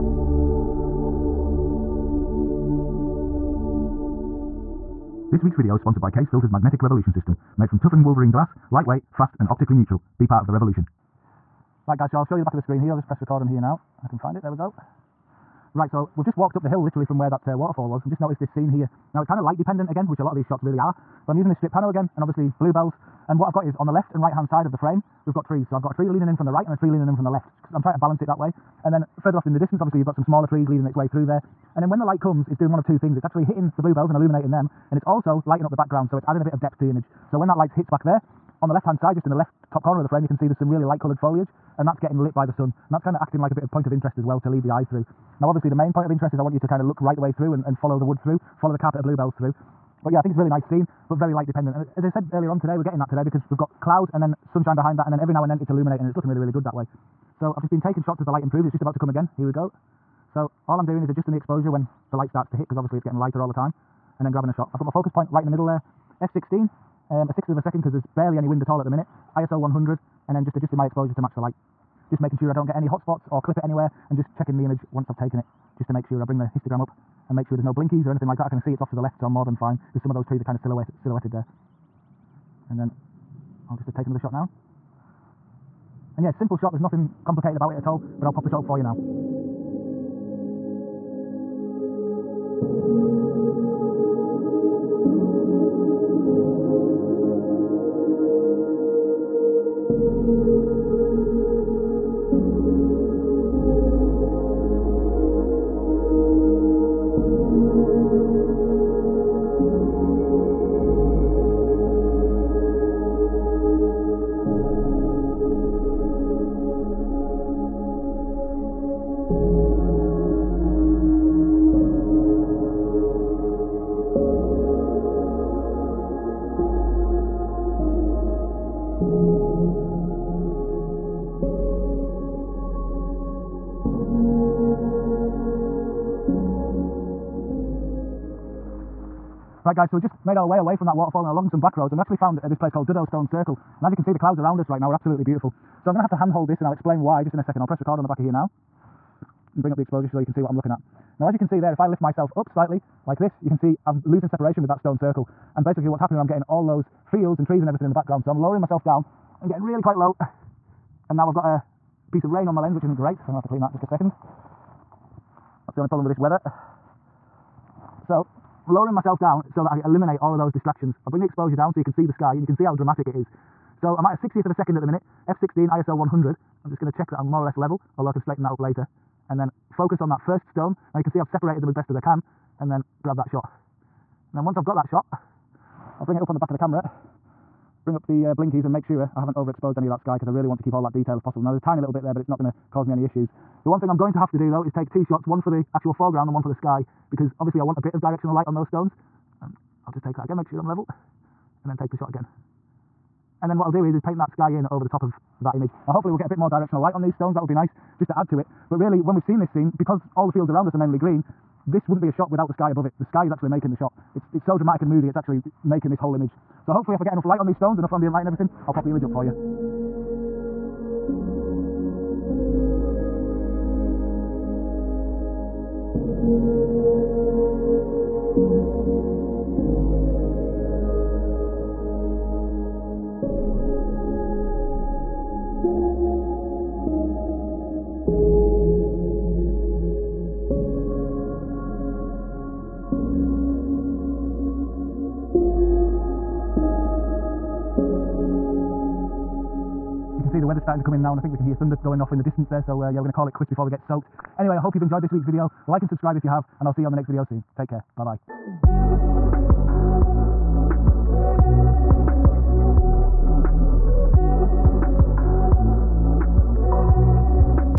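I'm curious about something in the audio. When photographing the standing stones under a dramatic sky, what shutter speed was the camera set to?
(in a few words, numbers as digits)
1/60 second.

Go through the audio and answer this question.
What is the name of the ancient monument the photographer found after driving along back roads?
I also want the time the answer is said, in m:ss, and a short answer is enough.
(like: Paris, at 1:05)
Duddo Stone Circle, at 2:22.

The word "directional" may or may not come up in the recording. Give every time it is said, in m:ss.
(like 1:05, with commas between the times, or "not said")
3:17, 3:26.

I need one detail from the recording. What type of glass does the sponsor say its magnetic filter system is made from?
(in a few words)
Wolverine glass.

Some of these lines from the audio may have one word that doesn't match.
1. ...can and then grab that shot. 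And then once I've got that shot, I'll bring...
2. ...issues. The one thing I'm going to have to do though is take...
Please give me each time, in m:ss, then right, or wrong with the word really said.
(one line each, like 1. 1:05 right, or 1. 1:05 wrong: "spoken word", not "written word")
1. 3:01 right
2. 3:13 right.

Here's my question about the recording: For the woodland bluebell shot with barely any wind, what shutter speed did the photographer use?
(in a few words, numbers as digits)
1/6 second.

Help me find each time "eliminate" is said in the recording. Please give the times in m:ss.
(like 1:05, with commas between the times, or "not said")
2:49.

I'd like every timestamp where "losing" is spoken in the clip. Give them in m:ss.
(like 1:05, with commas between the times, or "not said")
2:34.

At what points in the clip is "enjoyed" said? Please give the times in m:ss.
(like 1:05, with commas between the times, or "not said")
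4:14.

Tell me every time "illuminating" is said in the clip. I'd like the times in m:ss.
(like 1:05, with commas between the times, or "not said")
0:34, 0:55.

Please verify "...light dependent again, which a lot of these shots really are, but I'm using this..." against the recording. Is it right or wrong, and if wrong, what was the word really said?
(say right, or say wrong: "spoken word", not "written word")
right.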